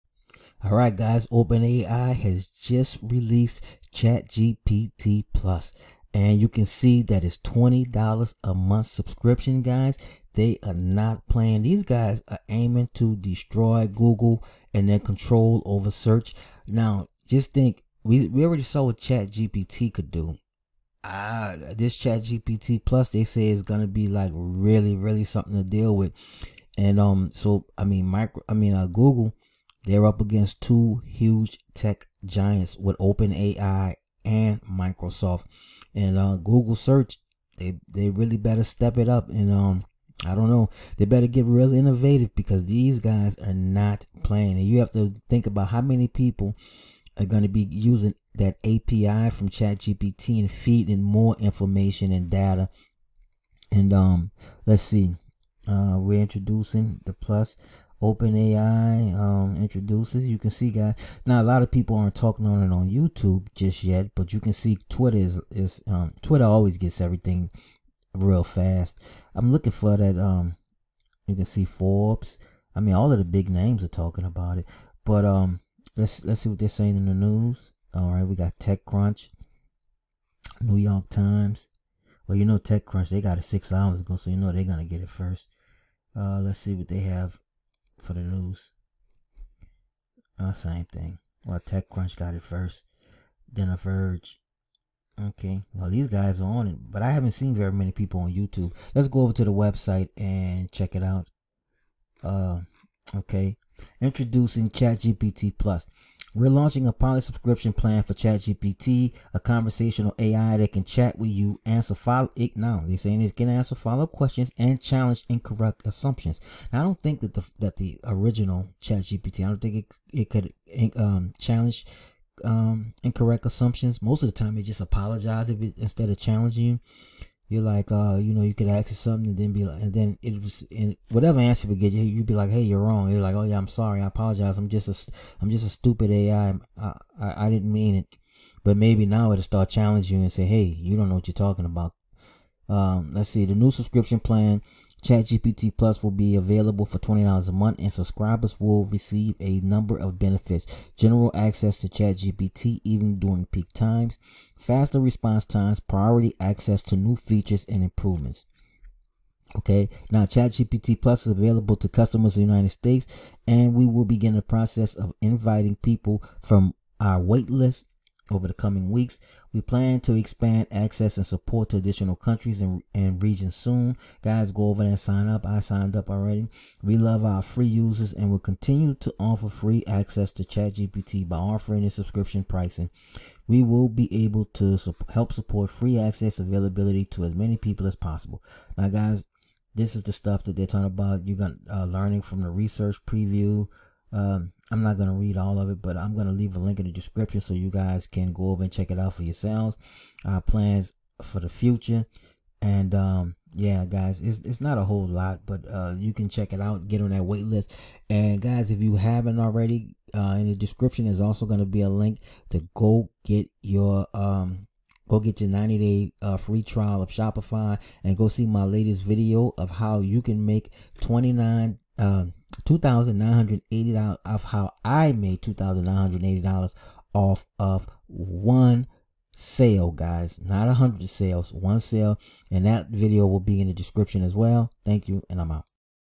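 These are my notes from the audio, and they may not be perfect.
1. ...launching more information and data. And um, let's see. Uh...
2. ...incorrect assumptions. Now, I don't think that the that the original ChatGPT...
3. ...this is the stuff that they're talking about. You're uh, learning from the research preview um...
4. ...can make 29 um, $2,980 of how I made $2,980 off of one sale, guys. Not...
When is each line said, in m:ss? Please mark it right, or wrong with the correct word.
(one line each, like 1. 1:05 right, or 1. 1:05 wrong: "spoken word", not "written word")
1. 0:50 wrong: "feeding", not "launching"
2. 1:55 right
3. 3:09 right
4. 3:40 right.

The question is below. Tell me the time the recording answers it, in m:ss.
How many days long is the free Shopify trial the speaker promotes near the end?
3:35.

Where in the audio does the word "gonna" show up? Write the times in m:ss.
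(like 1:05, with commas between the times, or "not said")
0:23, 1:24.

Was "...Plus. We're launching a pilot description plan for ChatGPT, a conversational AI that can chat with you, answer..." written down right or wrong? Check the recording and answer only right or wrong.
wrong.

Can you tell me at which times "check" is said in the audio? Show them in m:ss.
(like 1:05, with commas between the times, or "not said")
1:40, 3:18, 3:26.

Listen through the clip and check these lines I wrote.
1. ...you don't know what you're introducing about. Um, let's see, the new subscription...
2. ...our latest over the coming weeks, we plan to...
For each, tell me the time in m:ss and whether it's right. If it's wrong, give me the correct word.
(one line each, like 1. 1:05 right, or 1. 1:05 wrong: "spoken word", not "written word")
1. 2:20 wrong: "talking", not "introducing"
2. 2:46 wrong: "waitlist", not "latest".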